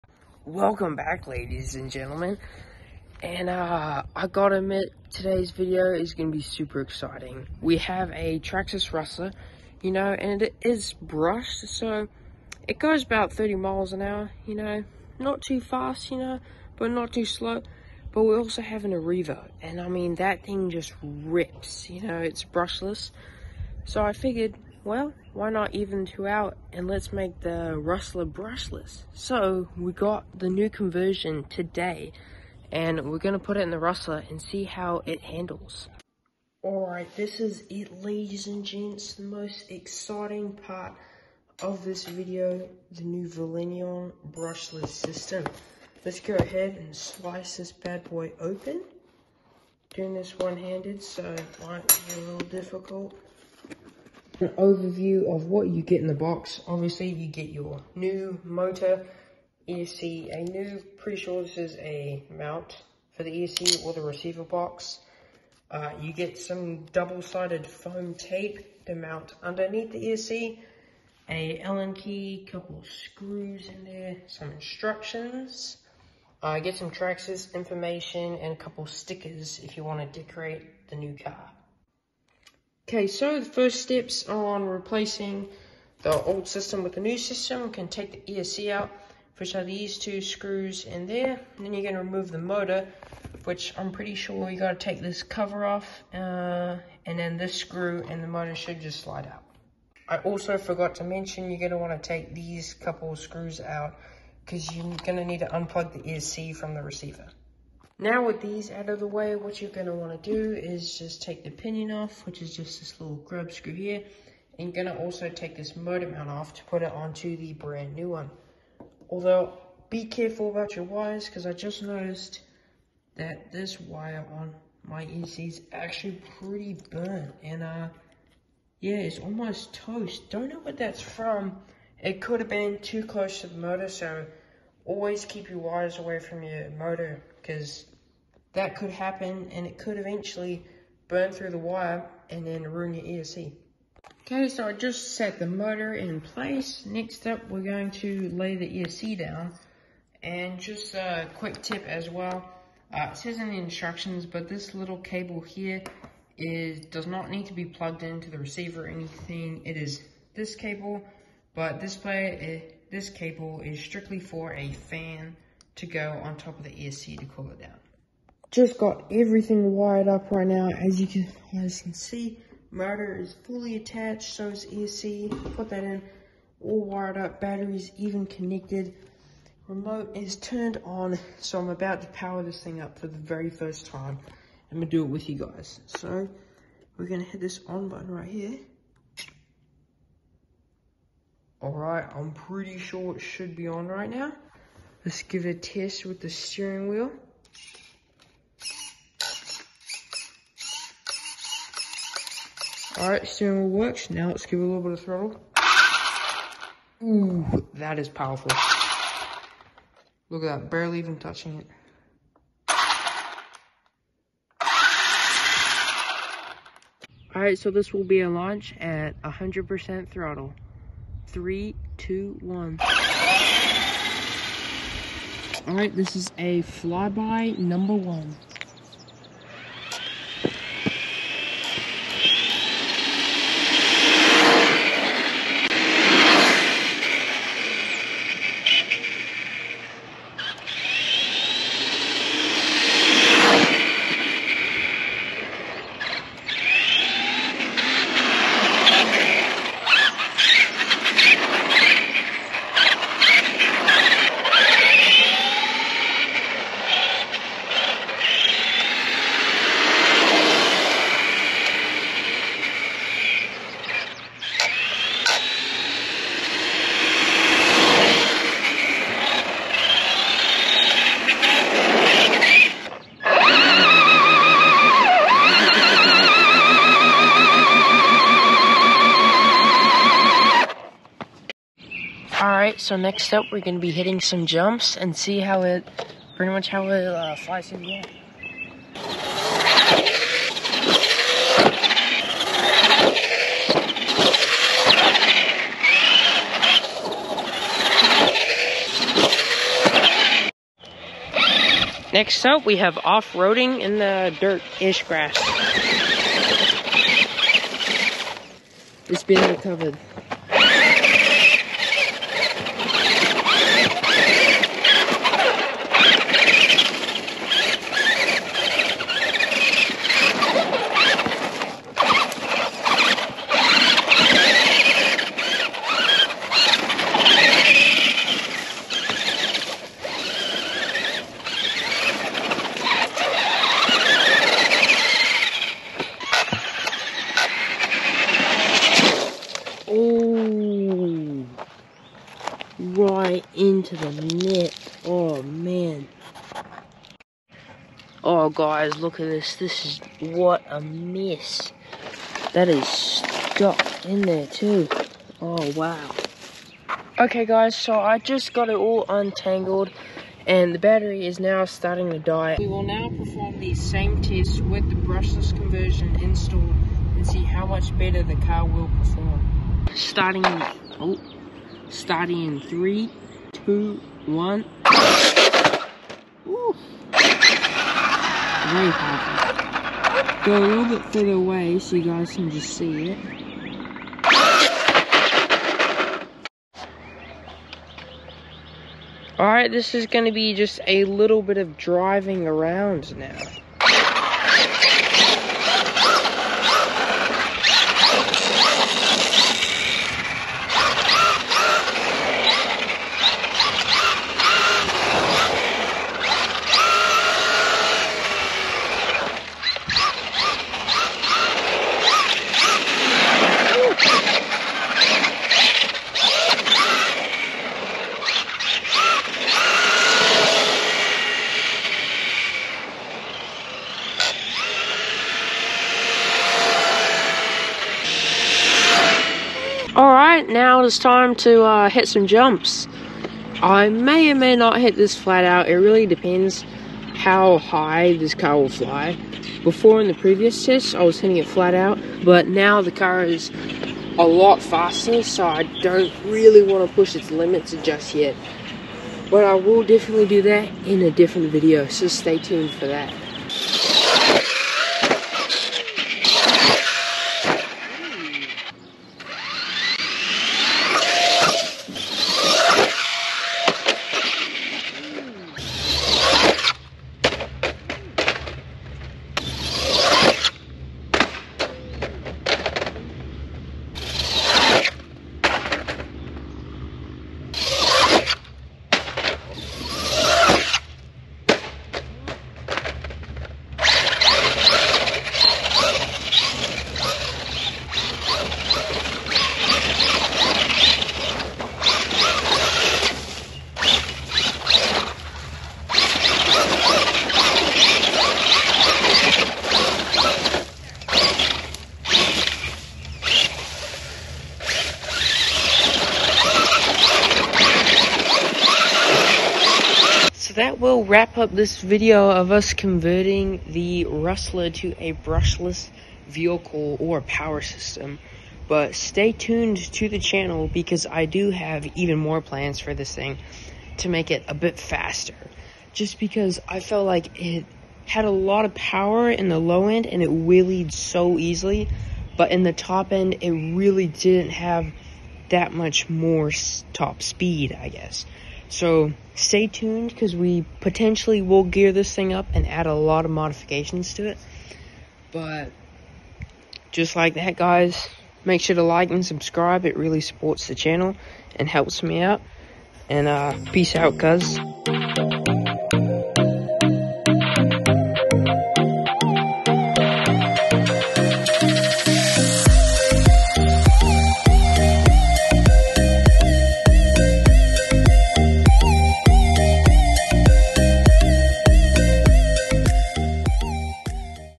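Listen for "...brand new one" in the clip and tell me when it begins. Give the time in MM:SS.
01:57.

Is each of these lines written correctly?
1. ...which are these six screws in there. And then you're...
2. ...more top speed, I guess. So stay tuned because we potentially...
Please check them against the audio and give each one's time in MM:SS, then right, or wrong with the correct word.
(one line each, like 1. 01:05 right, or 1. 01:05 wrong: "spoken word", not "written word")
1. 01:29 wrong: "two", not "six"
2. 08:56 right.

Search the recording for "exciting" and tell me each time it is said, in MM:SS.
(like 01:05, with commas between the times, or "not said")
00:06, 00:39.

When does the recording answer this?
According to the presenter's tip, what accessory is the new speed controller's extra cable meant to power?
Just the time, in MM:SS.
02:44.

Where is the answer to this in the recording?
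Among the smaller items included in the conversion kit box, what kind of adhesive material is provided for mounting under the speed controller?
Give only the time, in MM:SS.
01:06.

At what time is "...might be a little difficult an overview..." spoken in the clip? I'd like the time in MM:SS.
00:51.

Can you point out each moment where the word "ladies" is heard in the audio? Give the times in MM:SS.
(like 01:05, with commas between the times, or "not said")
00:01, 00:38.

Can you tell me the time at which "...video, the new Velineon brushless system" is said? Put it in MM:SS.
00:42.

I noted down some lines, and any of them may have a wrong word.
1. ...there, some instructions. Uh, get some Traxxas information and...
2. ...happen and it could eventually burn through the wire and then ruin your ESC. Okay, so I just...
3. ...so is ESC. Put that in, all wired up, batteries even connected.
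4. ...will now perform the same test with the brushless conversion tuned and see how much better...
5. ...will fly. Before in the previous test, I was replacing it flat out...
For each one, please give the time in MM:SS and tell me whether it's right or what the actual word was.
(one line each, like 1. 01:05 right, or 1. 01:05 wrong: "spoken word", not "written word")
1. 01:13 right
2. 02:18 right
3. 02:54 right
4. 06:02 wrong: "installed", not "tuned"
5. 07:18 wrong: "hitting", not "replacing".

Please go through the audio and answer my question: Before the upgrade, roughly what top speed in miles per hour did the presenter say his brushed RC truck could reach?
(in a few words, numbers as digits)
30.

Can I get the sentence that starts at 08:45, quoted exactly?
Just because I felt like it had a lot of power in the low end and it wheelied so easily.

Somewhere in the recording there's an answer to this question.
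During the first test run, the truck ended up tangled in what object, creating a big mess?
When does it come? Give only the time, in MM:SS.
05:43.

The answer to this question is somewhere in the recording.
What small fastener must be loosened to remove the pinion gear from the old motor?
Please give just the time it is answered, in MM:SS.
01:53.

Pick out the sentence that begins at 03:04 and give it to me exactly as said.
I'm gonna do it with you guys.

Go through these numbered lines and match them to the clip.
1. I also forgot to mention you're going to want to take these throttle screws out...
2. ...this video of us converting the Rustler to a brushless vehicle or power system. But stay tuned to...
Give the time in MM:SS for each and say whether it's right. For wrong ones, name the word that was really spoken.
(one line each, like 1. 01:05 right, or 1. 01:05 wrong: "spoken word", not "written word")
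1. 01:40 wrong: "couple", not "throttle"
2. 08:31 right.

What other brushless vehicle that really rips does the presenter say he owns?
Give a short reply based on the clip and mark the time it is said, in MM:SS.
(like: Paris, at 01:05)
Arrivo, at 00:18.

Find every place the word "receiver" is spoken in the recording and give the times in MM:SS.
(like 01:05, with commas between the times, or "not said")
01:04, 01:46, 02:38.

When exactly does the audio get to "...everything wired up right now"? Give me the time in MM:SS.
02:49.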